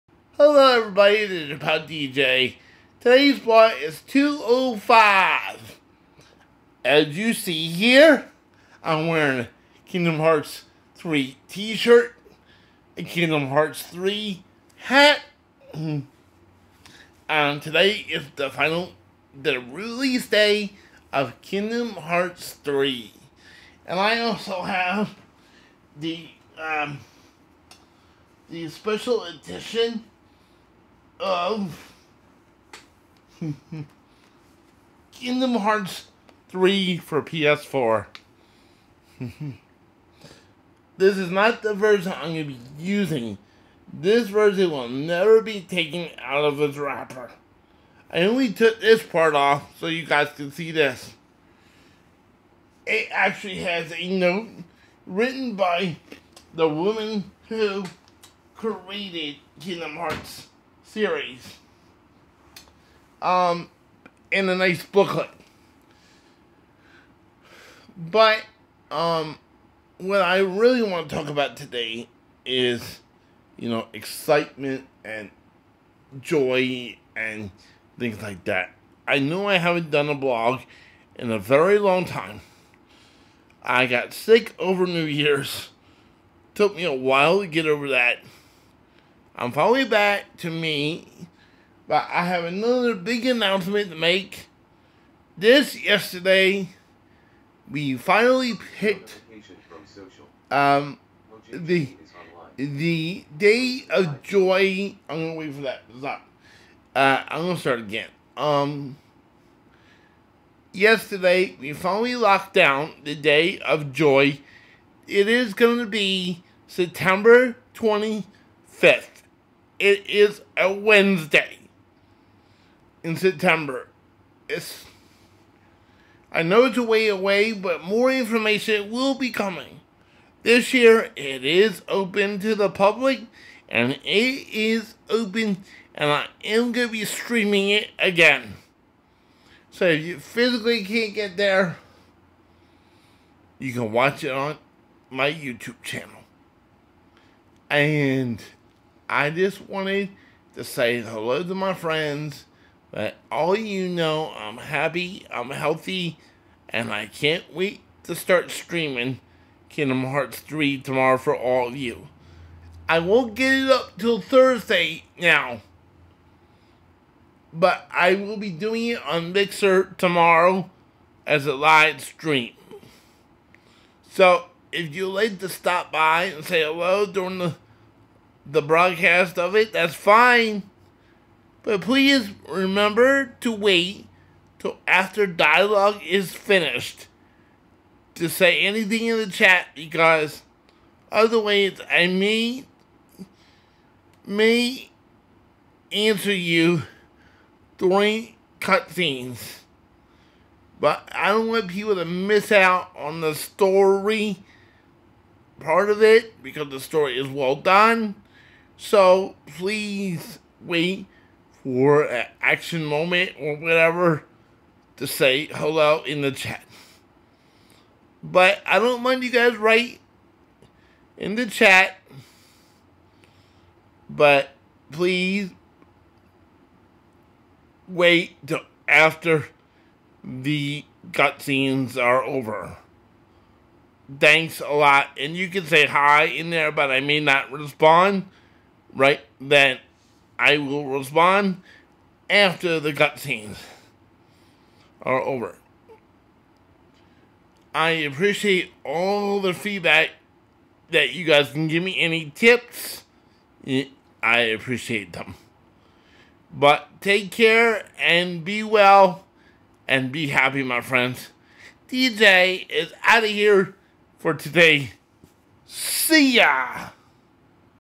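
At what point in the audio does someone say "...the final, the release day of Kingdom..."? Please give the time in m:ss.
0:18.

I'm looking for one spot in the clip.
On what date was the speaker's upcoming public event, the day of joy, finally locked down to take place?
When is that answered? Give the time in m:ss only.
1:56.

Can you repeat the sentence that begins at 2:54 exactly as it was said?
So, if you'd like to stop by and say hello during the the broadcast of it, that's fine.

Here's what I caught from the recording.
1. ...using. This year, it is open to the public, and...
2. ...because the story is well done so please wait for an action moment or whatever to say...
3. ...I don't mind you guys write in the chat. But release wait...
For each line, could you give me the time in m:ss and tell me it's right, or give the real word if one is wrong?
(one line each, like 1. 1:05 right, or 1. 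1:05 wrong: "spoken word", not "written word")
1. 2:09 wrong: "coming", not "using"
2. 3:26 right
3. 3:38 wrong: "please", not "release".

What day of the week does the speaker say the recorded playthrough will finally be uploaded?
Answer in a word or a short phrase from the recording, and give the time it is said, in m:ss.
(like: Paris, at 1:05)
Thursday, at 2:44.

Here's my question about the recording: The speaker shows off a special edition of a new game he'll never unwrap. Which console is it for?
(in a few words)
PS4.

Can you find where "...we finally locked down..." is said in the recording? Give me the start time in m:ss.
1:51.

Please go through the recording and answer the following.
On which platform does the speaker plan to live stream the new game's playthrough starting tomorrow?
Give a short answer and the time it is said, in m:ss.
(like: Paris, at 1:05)
Mixer, at 2:49.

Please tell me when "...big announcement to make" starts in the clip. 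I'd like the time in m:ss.
1:32.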